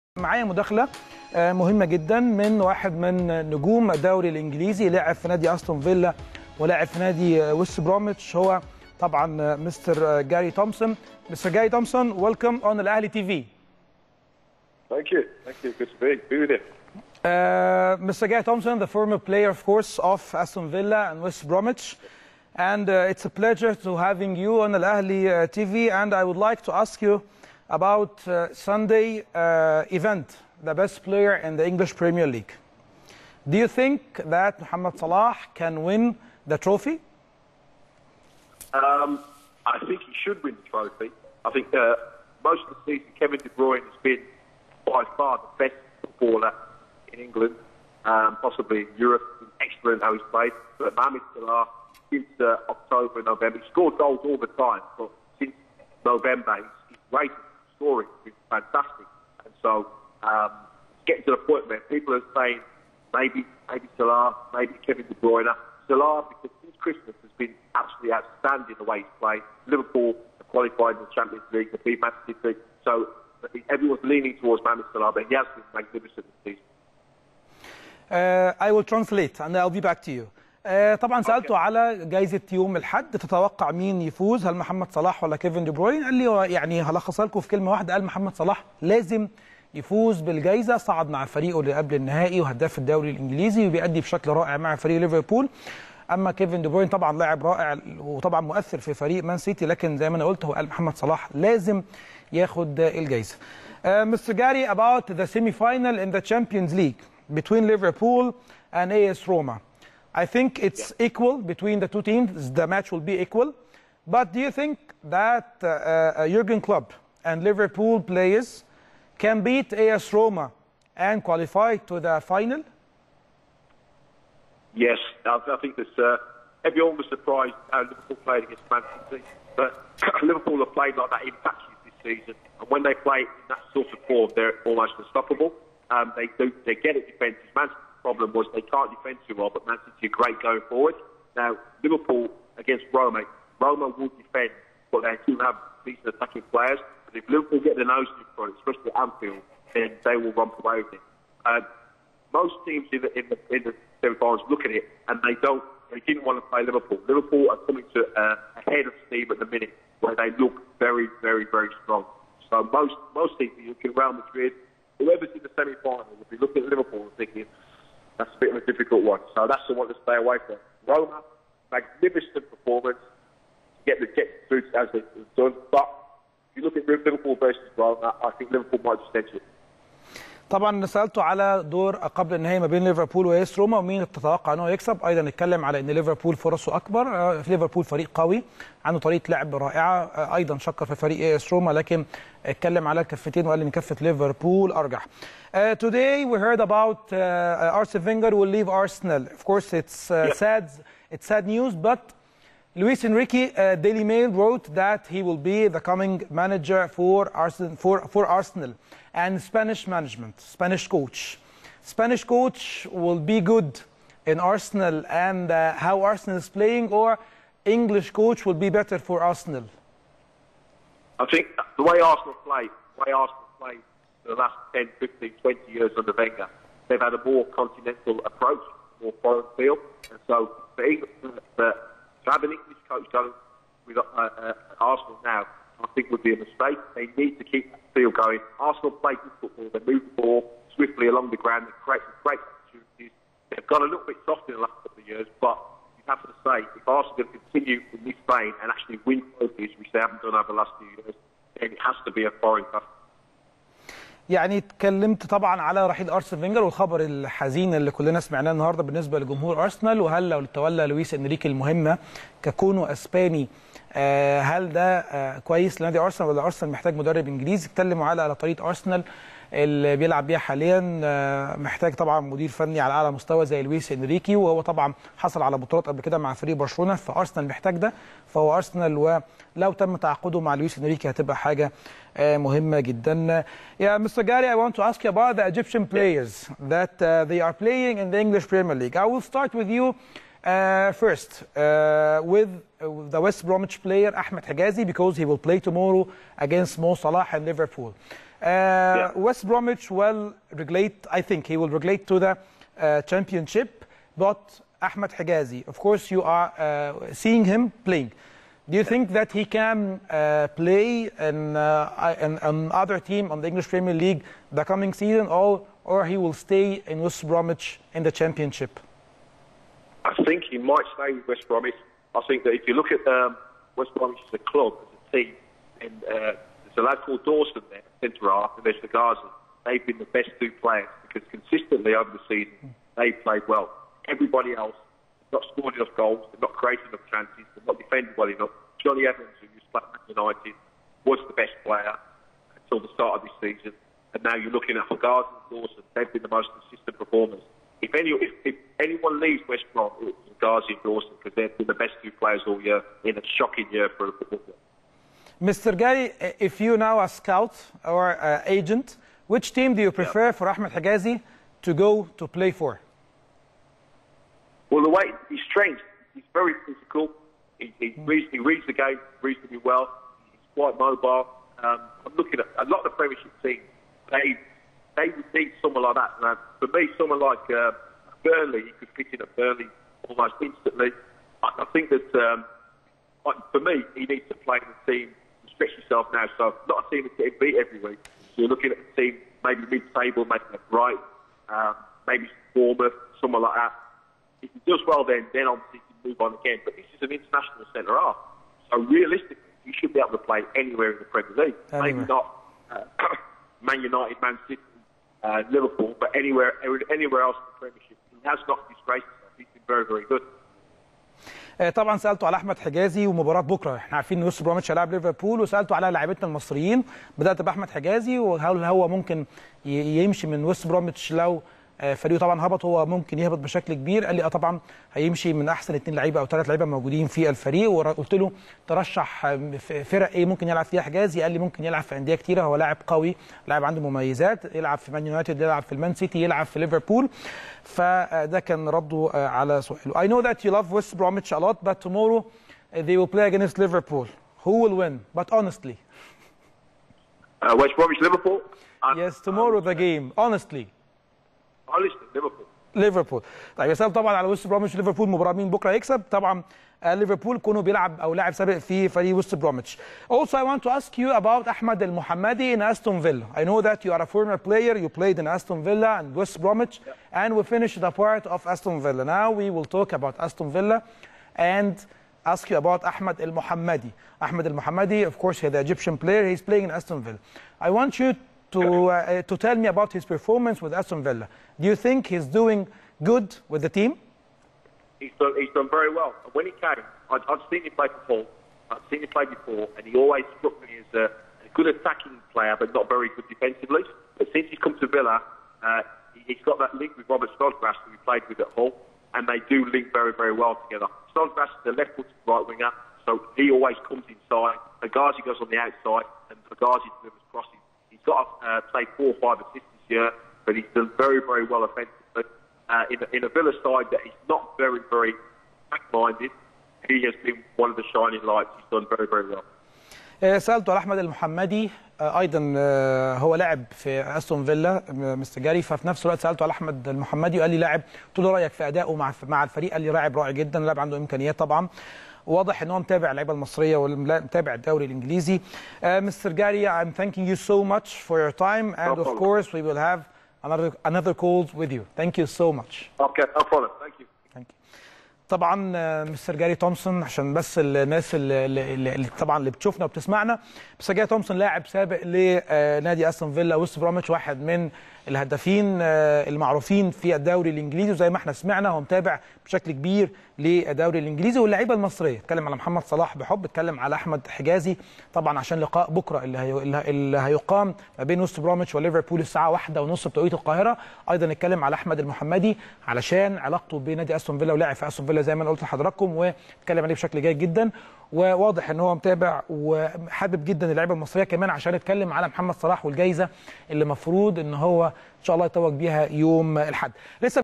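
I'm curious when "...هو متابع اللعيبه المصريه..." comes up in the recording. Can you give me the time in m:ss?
8:52.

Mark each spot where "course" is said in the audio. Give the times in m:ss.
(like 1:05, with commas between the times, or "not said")
3:19, 5:05, 7:55.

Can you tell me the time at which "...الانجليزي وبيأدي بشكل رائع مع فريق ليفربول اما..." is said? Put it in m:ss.
1:33.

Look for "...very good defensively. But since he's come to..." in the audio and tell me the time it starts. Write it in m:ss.
8:12.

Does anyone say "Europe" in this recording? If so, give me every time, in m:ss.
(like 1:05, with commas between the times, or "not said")
0:48.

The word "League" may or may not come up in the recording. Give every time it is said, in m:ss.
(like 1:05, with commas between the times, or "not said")
0:32, 1:11, 1:46, 4:48, 5:13, 6:41.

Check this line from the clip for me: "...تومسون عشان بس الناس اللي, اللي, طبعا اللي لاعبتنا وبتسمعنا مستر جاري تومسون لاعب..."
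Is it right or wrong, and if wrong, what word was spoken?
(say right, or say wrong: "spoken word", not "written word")
wrong: "بتشوفنا", not "لاعبتنا".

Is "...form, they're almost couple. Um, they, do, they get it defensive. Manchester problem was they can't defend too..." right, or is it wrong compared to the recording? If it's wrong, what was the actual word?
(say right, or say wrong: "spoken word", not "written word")
wrong: "unstoppable", not "couple".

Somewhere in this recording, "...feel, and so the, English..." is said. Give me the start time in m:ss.
3:49.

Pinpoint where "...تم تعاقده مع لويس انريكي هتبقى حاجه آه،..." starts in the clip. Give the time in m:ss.
4:39.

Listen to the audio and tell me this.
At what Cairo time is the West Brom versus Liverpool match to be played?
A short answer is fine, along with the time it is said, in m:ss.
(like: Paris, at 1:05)
1:30, at 9:29.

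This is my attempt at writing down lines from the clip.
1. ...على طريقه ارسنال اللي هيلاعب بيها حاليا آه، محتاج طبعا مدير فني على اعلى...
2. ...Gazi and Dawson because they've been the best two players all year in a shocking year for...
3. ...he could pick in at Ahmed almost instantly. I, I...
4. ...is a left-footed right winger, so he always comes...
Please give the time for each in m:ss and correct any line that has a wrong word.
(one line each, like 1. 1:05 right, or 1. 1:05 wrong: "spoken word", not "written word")
1. 4:28 wrong: "بيلعب", not "هيلاعب"
2. 5:50 right
3. 6:18 wrong: "Burnley", not "Ahmed"
4. 8:21 right.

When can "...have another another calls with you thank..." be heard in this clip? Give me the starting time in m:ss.
9:00.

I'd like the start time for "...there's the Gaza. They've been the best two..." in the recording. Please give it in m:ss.
5:28.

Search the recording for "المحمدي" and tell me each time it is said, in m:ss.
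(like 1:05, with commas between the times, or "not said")
7:41, 8:40, 8:46, 9:31.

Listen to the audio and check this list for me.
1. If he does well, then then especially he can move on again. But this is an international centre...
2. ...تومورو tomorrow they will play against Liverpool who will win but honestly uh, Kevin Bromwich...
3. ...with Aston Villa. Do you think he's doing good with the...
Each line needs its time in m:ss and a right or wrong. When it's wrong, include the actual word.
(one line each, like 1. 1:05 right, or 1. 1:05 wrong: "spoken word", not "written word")
1. 6:34 wrong: "obviously", not "especially"
2. 7:21 wrong: "West", not "Kevin"
3. 8:00 right.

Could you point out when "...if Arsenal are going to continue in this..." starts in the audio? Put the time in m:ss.
4:06.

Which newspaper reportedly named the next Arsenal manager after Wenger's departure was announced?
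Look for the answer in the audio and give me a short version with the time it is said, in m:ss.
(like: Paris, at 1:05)
Daily Mail, at 3:23.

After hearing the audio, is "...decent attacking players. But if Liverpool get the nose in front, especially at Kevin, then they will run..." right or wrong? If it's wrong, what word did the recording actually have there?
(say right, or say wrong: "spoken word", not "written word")
wrong: "Anfield", not "Kevin".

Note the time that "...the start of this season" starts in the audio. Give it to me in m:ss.
5:42.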